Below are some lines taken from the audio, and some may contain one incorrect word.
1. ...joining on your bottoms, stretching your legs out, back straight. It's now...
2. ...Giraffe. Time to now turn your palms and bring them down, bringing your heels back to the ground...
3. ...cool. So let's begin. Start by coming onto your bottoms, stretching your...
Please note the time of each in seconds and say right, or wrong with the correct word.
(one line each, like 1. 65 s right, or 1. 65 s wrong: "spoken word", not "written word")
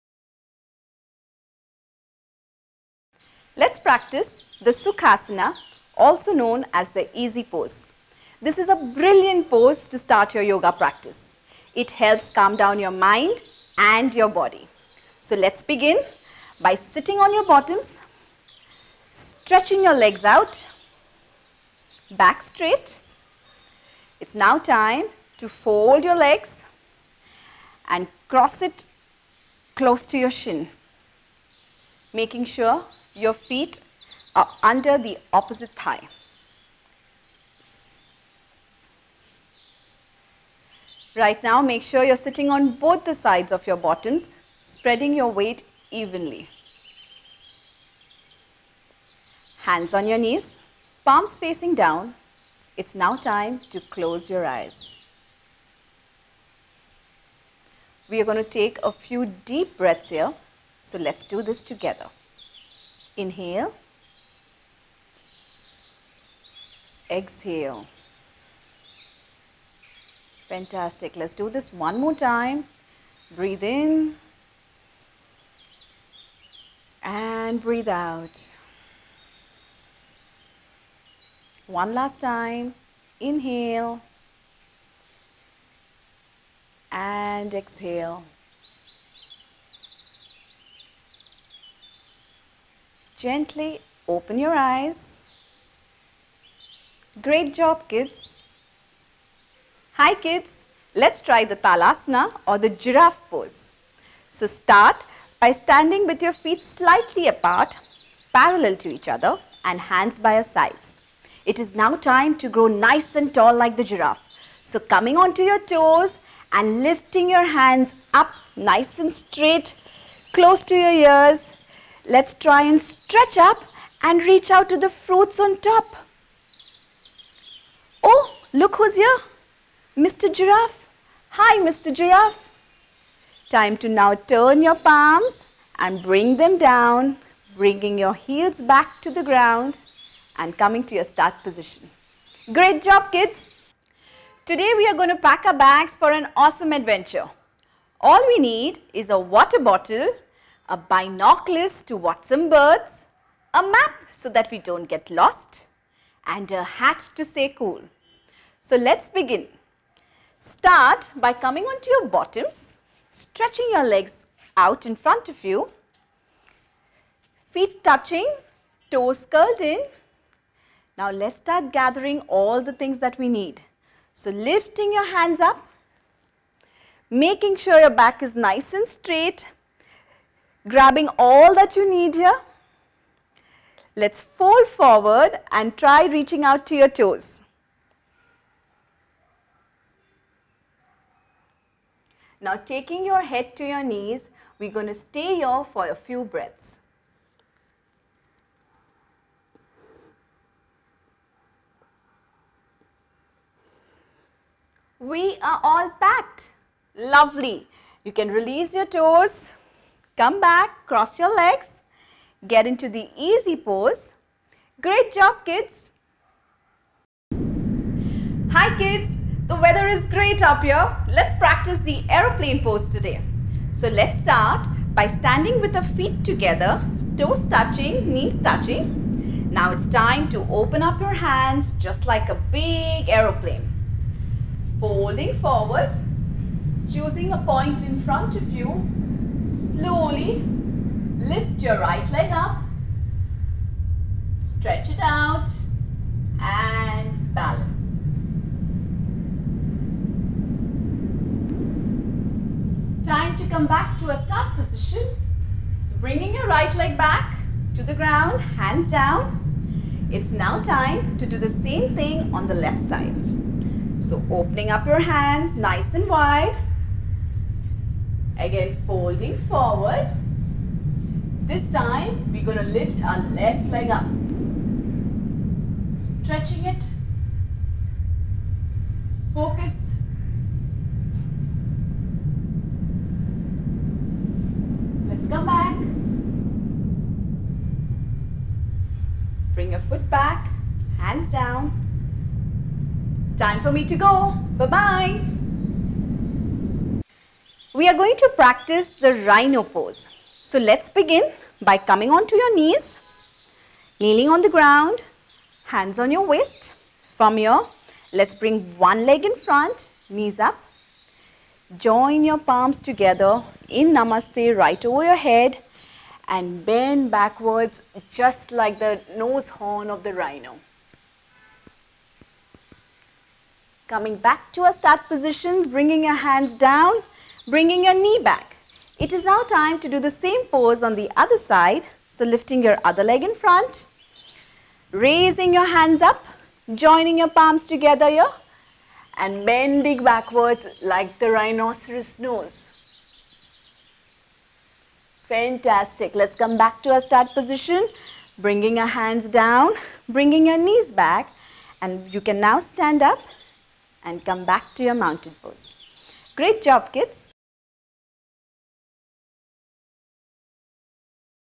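1. 16 s wrong: "sitting", not "joining"
2. 131 s right
3. 157 s right.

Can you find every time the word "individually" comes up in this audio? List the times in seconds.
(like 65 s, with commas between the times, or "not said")
not said.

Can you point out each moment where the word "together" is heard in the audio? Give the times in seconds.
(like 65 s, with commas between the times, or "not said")
61 s, 226 s, 312 s, 337 s.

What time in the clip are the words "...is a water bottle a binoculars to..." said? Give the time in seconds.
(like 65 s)
148 s.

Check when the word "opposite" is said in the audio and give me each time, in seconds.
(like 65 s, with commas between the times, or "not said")
35 s.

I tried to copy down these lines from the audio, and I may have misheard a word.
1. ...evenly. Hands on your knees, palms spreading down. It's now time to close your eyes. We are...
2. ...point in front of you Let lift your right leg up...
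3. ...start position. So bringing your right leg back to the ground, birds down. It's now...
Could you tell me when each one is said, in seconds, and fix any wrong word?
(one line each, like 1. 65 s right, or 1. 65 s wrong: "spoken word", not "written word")
1. 45 s wrong: "facing", not "spreading"
2. 237 s wrong: "Slowly", not "Let"
3. 254 s wrong: "hands", not "birds".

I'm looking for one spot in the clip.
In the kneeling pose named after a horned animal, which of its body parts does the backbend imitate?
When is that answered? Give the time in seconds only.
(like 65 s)
319 s.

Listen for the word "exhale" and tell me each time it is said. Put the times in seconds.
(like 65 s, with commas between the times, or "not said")
67 s, 87 s.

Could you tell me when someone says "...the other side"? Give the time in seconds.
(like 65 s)
330 s.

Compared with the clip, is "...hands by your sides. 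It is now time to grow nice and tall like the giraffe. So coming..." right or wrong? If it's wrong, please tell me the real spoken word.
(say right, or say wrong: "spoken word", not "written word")
right.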